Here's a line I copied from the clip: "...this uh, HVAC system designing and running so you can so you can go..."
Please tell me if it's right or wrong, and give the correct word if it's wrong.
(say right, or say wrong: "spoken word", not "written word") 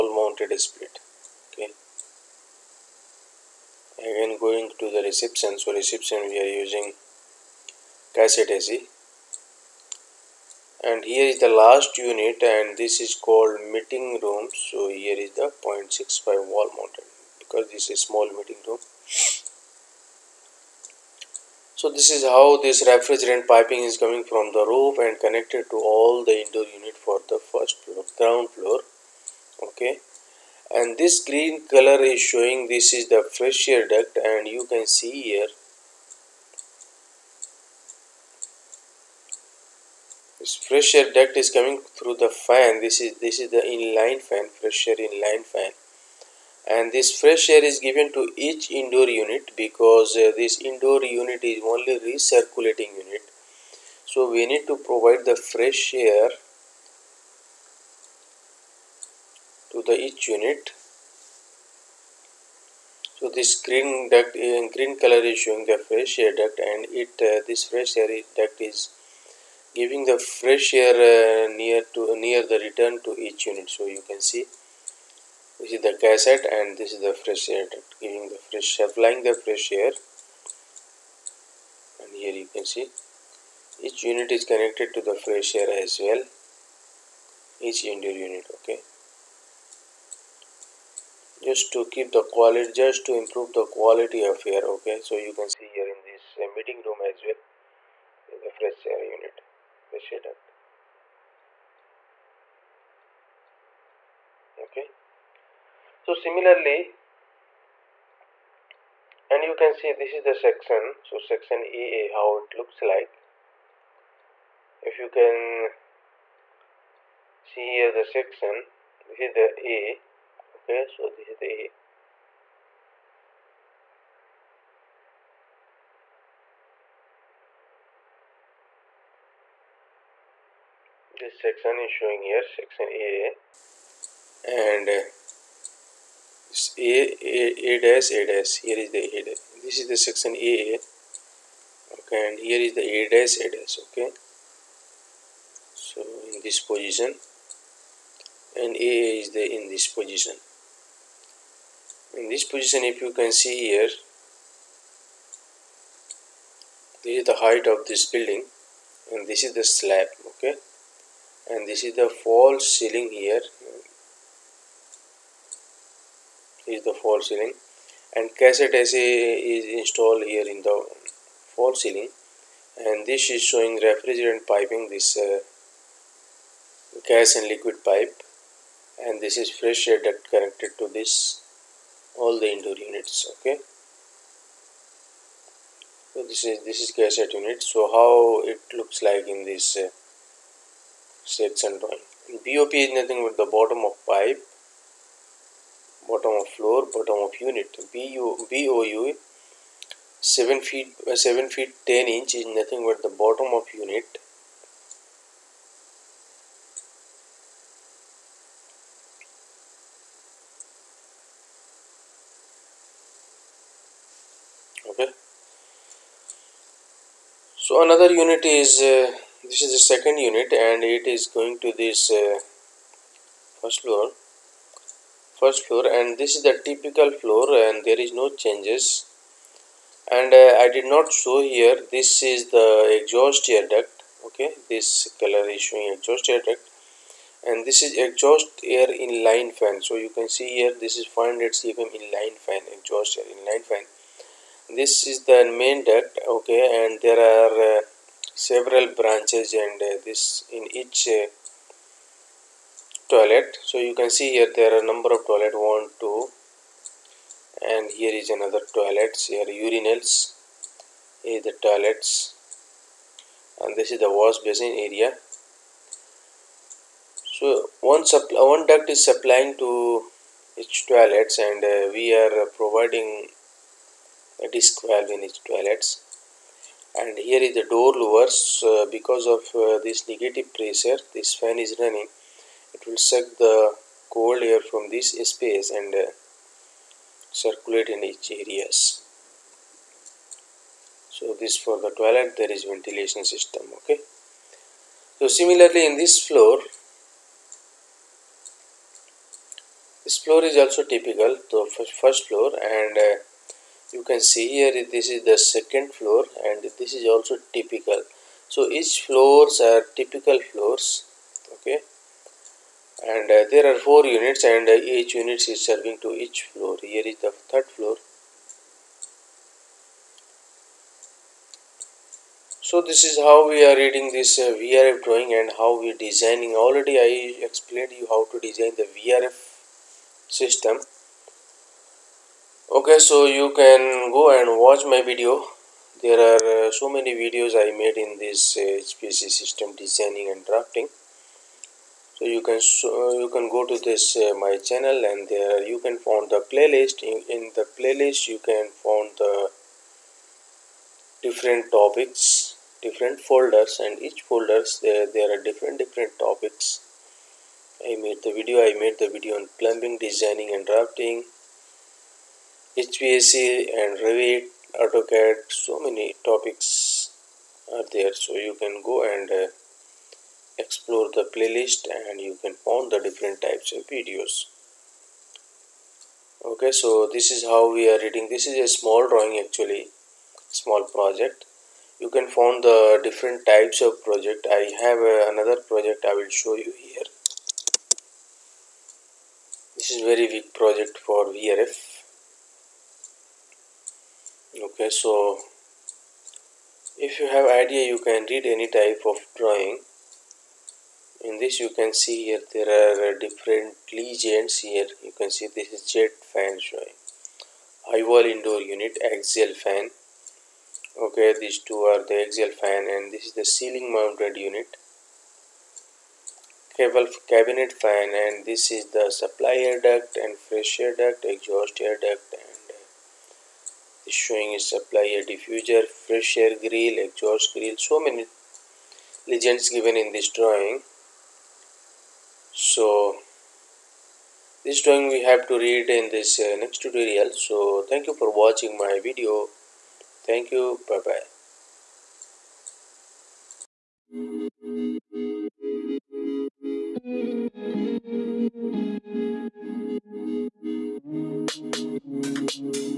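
wrong: "drafting", not "running".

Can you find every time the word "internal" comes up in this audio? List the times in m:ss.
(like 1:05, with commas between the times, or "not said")
not said.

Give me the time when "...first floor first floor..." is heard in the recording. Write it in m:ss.
3:43.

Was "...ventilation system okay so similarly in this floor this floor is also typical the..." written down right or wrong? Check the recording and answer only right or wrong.
right.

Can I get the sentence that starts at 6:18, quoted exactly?
This is a small drawing actually, small project.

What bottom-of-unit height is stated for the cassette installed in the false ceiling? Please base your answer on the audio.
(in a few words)
7 feet 10 inches.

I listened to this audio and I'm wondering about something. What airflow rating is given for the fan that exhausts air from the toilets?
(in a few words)
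500 cfm.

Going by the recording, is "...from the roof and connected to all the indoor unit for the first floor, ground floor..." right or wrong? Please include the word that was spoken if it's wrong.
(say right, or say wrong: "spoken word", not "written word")
right.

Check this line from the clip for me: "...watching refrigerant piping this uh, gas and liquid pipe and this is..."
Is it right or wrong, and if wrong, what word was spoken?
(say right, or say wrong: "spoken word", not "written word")
wrong: "showing", not "watching".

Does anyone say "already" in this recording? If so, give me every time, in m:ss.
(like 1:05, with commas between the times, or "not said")
5:26.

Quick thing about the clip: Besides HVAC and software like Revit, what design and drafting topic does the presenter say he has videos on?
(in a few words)
plumbing.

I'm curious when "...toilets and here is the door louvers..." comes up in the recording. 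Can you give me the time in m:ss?
4:35.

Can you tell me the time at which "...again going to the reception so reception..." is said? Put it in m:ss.
0:04.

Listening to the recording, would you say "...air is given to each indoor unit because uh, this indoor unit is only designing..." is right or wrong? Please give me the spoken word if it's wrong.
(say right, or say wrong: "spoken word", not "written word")
wrong: "recirculating", not "designing".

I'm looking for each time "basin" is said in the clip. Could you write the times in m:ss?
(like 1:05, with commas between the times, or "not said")
4:24.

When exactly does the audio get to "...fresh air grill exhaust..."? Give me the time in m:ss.
7:06.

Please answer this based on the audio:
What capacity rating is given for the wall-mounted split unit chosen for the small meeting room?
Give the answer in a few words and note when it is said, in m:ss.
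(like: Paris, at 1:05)
0.65, at 0:15.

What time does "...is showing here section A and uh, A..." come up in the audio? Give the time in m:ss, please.
2:11.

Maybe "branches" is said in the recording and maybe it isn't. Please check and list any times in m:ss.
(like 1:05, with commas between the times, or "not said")
4:08.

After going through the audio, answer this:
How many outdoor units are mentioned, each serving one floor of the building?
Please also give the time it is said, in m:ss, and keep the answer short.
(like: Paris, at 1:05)
4, at 5:13.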